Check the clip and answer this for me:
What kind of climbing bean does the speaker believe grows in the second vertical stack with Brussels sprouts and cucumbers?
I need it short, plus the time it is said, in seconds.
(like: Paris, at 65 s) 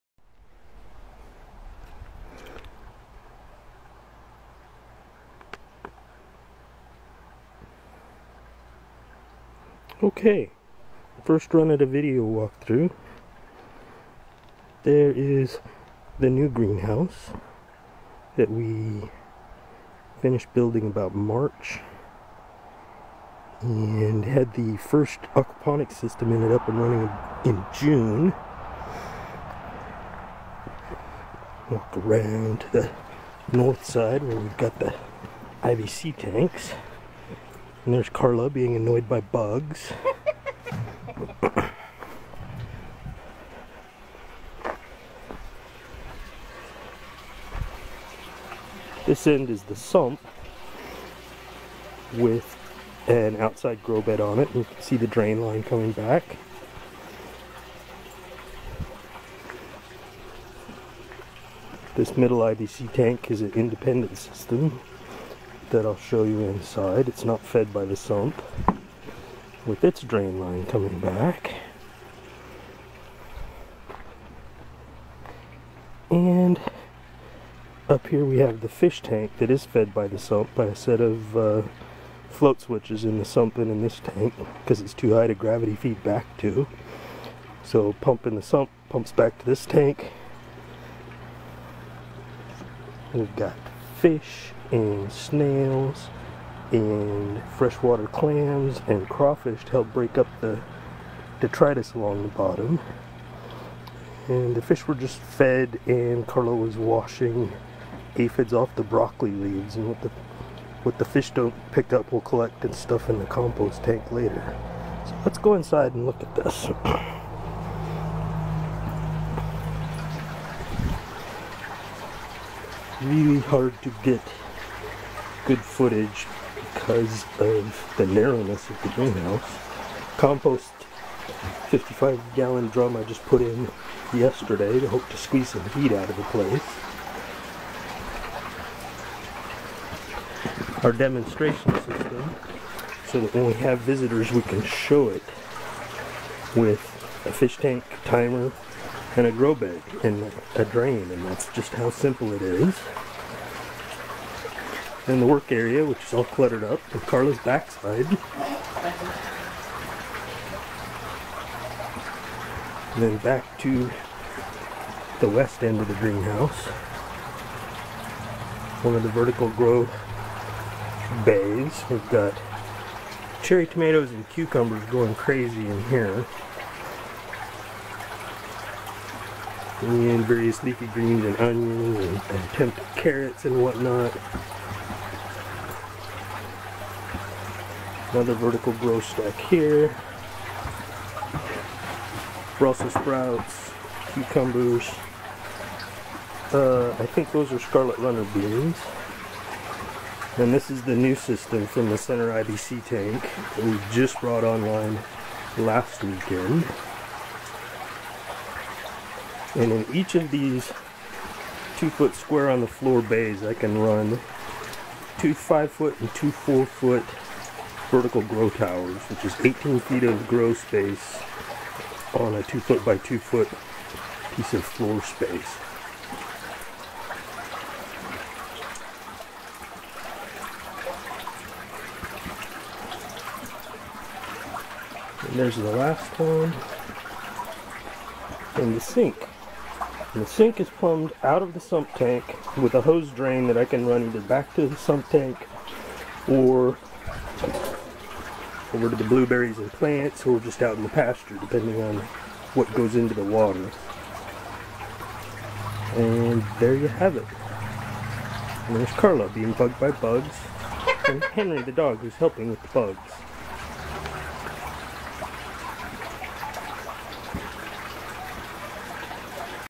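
Scarlet runner beans, at 197 s.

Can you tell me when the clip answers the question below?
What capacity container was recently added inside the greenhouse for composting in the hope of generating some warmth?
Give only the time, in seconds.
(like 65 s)
131 s.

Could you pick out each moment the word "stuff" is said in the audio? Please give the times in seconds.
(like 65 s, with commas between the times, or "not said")
112 s.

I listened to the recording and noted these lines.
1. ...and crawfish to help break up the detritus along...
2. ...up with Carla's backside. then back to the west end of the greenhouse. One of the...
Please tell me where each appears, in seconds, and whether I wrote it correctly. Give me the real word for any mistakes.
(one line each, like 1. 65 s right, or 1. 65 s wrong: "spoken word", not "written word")
1. 98 s right
2. 156 s right.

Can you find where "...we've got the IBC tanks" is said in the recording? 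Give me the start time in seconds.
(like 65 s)
34 s.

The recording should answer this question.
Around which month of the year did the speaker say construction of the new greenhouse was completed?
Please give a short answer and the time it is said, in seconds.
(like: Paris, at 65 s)
March, at 21 s.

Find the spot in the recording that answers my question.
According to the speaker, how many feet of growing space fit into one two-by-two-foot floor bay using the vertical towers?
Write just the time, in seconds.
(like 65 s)
219 s.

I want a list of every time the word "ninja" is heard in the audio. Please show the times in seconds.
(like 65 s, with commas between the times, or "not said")
not said.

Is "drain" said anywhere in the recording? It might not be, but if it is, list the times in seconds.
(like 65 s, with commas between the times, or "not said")
55 s, 70 s, 150 s, 243 s.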